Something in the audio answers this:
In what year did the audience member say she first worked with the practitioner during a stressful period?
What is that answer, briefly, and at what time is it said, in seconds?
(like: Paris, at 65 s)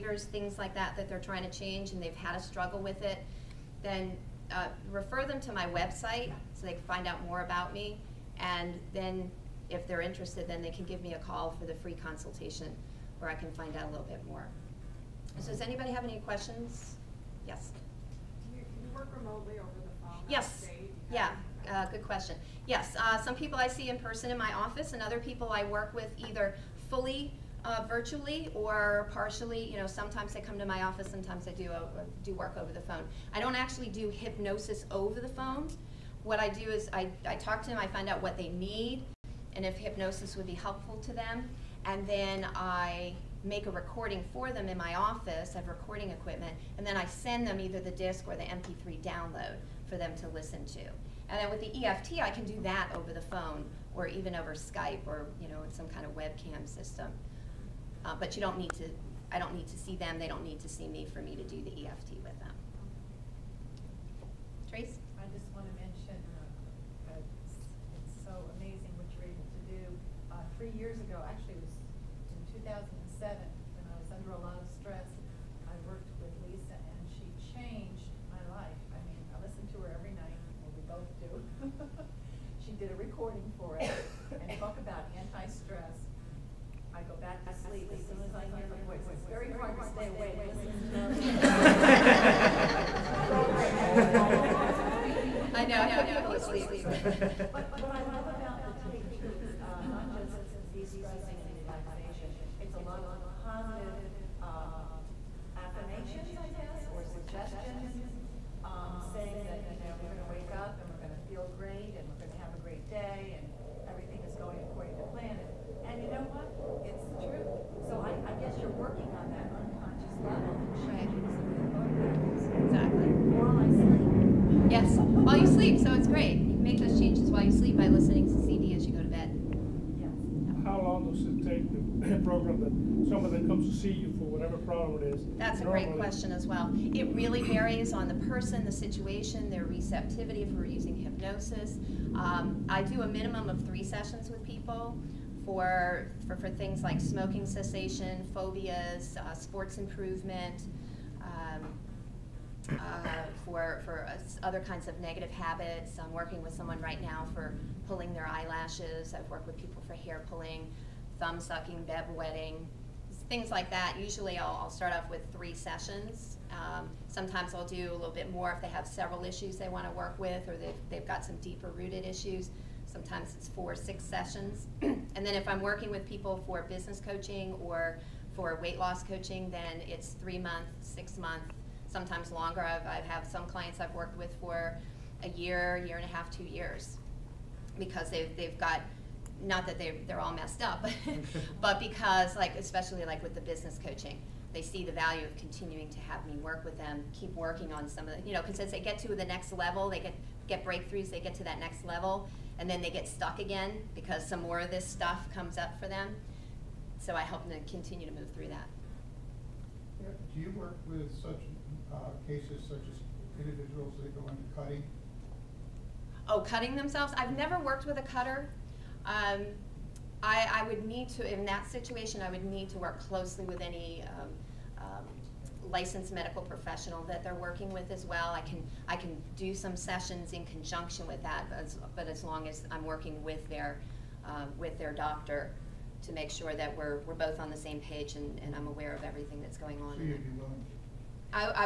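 2007, at 72 s.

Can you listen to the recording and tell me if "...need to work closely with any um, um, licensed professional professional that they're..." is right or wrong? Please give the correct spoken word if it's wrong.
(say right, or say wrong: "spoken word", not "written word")
wrong: "medical", not "professional".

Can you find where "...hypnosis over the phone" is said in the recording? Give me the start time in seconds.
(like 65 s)
34 s.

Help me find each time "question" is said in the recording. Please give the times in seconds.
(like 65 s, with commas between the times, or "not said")
16 s, 22 s, 135 s.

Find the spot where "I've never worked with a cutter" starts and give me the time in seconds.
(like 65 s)
217 s.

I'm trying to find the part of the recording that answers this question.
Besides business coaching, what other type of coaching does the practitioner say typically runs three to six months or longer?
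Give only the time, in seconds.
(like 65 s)
178 s.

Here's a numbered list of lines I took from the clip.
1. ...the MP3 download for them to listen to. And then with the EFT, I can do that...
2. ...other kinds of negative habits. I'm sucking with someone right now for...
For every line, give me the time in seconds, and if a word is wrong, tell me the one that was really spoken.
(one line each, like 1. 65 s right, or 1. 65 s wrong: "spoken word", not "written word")
1. 48 s right
2. 154 s wrong: "working", not "sucking".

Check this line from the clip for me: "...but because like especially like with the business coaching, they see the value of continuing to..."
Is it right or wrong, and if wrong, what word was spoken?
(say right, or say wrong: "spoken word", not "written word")
right.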